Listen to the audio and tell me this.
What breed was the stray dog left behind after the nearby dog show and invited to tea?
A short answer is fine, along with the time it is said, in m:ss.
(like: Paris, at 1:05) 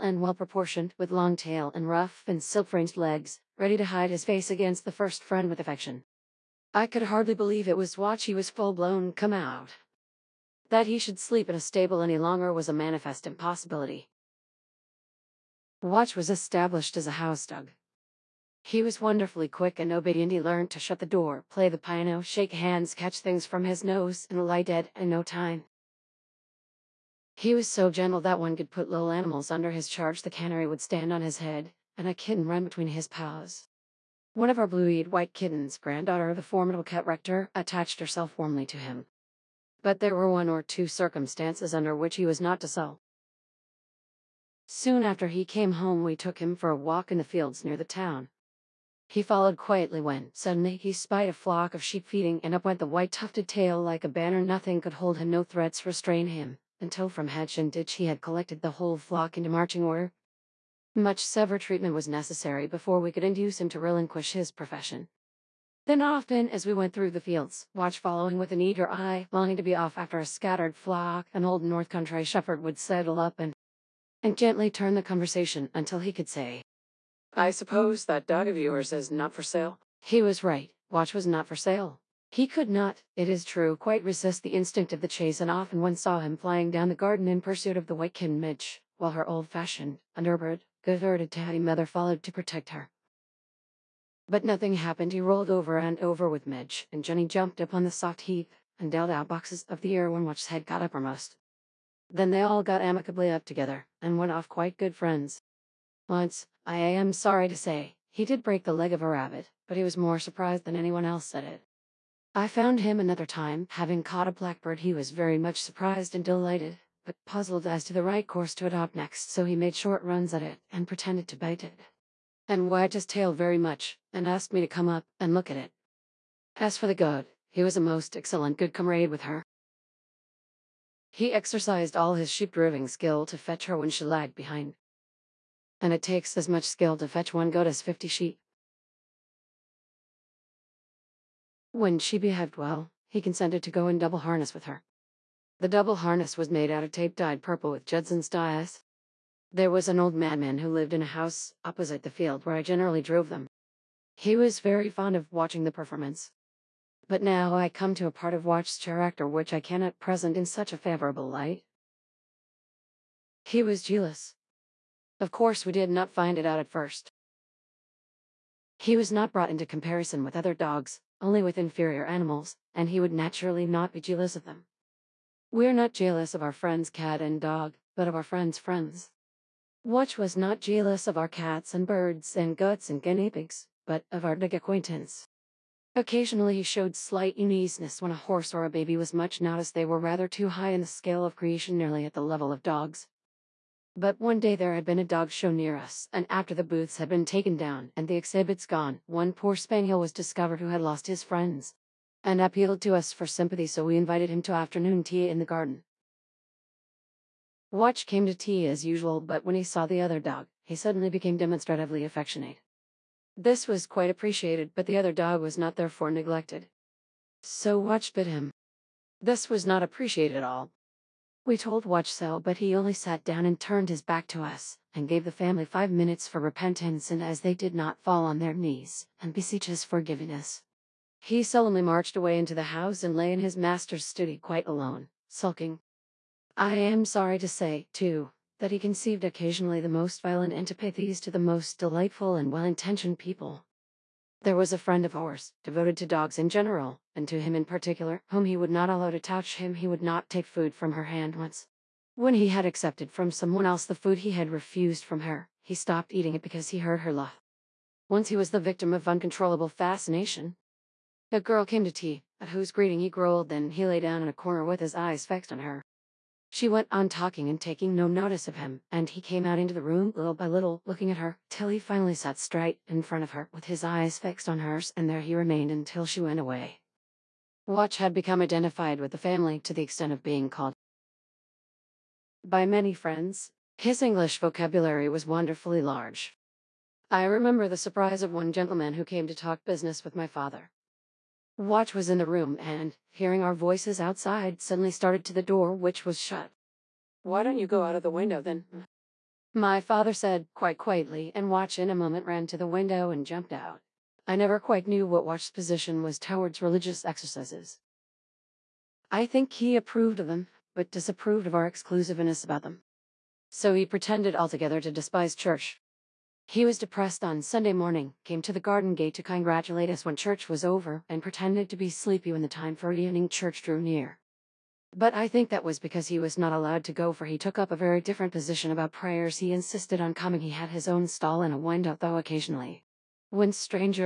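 Spaniel, at 3:19.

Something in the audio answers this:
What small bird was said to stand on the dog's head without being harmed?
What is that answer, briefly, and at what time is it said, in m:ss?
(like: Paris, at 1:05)
Canary, at 0:30.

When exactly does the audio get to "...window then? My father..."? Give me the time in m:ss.
4:58.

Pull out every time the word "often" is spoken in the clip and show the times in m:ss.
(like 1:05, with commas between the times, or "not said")
1:06, 1:25.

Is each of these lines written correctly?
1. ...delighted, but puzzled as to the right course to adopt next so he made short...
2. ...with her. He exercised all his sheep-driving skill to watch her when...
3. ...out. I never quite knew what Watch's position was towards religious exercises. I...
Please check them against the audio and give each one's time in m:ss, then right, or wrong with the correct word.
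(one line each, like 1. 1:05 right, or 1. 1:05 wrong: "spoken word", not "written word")
1. 1:56 right
2. 2:09 wrong: "fetch", not "watch"
3. 5:03 right.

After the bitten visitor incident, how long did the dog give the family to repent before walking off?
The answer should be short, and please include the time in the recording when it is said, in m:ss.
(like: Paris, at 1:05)
5 minutes, at 3:45.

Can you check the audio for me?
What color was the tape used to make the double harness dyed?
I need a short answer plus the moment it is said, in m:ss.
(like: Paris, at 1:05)
Purple, at 2:27.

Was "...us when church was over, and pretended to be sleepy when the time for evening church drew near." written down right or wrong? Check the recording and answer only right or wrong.
right.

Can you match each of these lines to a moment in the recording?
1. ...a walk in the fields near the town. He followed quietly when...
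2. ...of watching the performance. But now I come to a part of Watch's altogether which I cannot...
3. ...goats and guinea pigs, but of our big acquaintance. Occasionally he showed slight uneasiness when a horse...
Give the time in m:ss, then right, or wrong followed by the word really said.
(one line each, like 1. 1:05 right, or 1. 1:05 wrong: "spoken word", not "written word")
1. 0:46 right
2. 2:35 wrong: "character", not "altogether"
3. 3:02 right.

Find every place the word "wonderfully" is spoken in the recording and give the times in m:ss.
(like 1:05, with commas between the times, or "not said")
0:19, 4:45.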